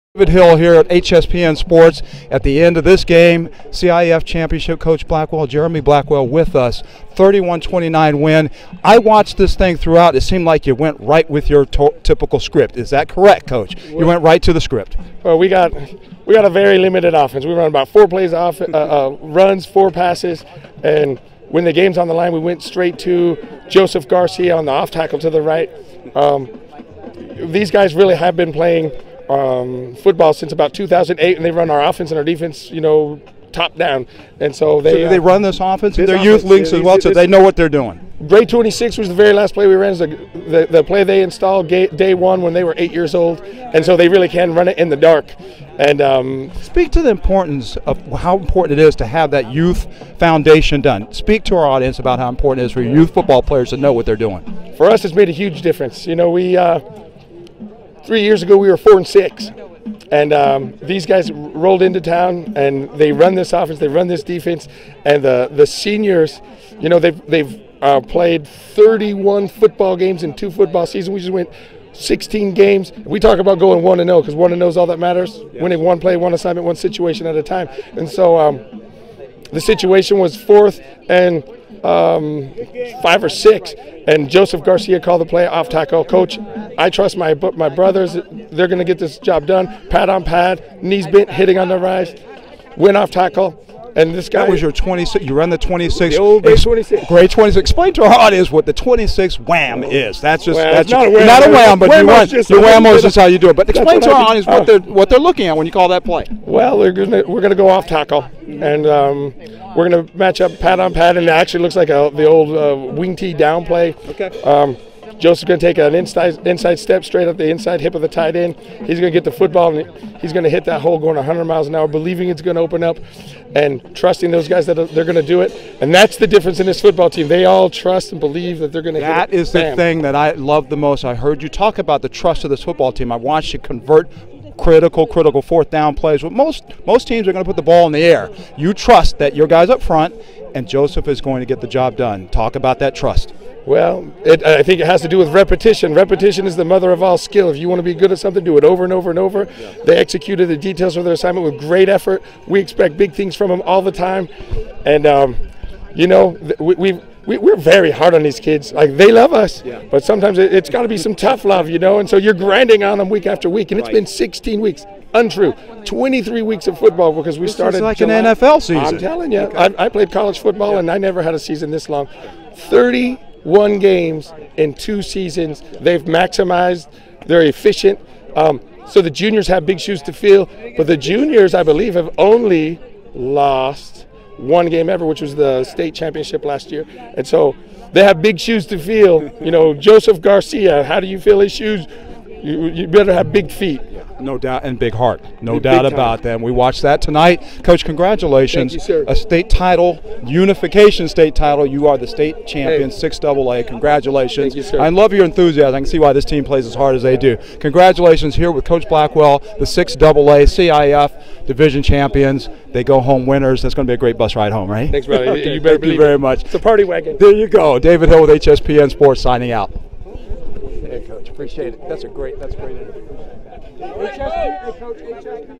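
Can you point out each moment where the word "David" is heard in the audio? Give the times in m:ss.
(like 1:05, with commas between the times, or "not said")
0:00, 3:37.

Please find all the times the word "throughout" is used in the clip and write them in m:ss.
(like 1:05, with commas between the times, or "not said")
0:09.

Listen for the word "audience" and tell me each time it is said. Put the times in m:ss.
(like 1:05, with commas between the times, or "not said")
0:51, 1:38, 1:44.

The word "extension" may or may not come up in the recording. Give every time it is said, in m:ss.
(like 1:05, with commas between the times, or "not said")
not said.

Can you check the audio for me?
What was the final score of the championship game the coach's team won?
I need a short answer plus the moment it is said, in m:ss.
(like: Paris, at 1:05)
31-29, at 0:07.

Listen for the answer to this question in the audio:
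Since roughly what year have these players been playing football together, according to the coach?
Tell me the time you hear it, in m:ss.
0:30.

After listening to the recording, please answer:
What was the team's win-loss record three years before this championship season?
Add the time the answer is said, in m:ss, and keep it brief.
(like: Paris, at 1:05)
4 and 6, at 0:58.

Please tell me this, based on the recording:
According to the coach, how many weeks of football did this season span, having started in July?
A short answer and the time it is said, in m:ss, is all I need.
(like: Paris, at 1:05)
23, at 2:45.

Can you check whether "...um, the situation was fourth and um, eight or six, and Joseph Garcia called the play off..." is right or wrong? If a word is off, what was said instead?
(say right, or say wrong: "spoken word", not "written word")
wrong: "five", not "eight".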